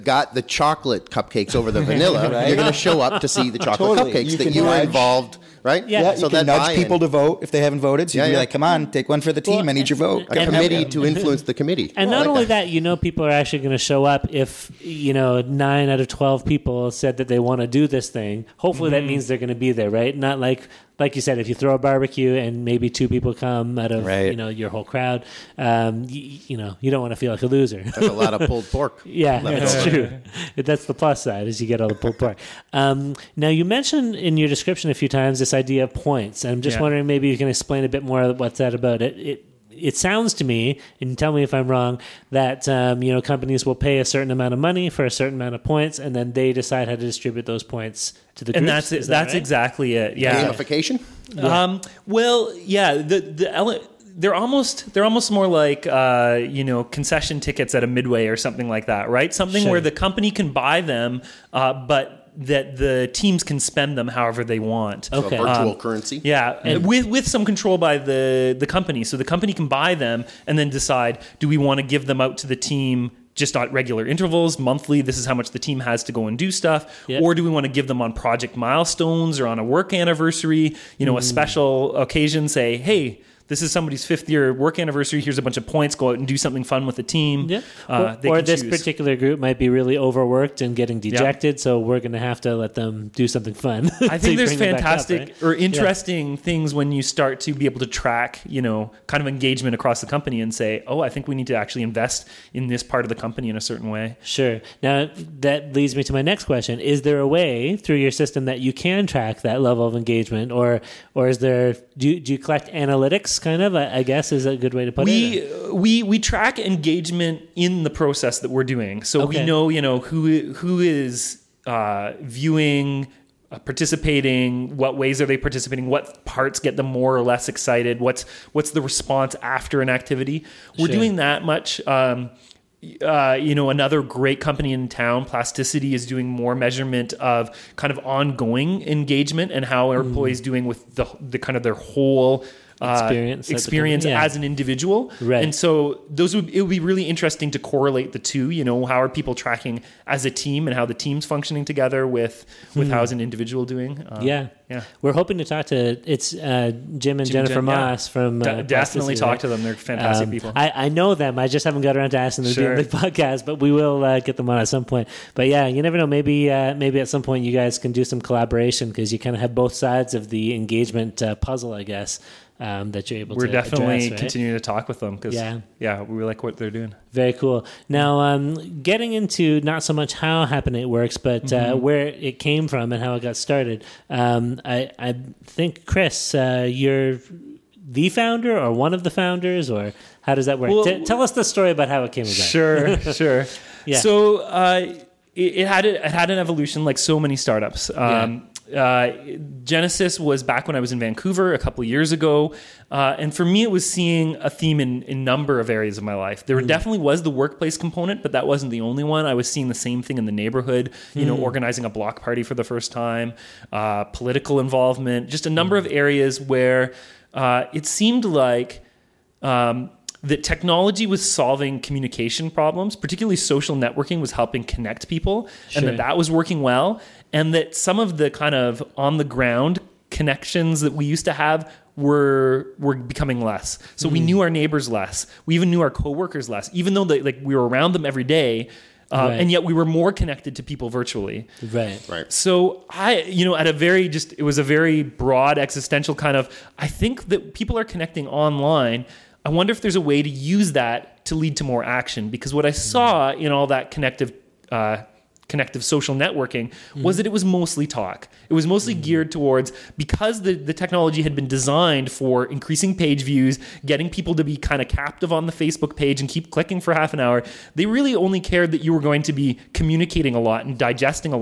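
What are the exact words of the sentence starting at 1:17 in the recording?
or do we want to give them on project milestones or on a work anniversary?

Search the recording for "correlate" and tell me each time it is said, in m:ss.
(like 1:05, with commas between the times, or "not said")
2:27.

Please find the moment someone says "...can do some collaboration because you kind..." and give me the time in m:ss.
2:47.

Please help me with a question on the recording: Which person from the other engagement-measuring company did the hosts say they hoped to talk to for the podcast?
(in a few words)
Jennifer Moss.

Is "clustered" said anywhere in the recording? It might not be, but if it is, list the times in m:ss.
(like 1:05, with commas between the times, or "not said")
not said.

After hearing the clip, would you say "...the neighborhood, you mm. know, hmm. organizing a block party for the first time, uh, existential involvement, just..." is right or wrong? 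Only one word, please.
wrong.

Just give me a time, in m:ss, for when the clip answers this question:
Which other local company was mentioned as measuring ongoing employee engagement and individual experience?
2:15.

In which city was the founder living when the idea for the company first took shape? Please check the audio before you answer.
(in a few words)
Vancouver.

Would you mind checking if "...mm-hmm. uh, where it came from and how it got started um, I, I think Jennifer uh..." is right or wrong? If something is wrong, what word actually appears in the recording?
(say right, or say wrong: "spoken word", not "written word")
wrong: "Kris", not "Jennifer".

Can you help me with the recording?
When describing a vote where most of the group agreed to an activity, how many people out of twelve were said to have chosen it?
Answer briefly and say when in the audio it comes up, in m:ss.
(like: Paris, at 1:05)
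9, at 0:15.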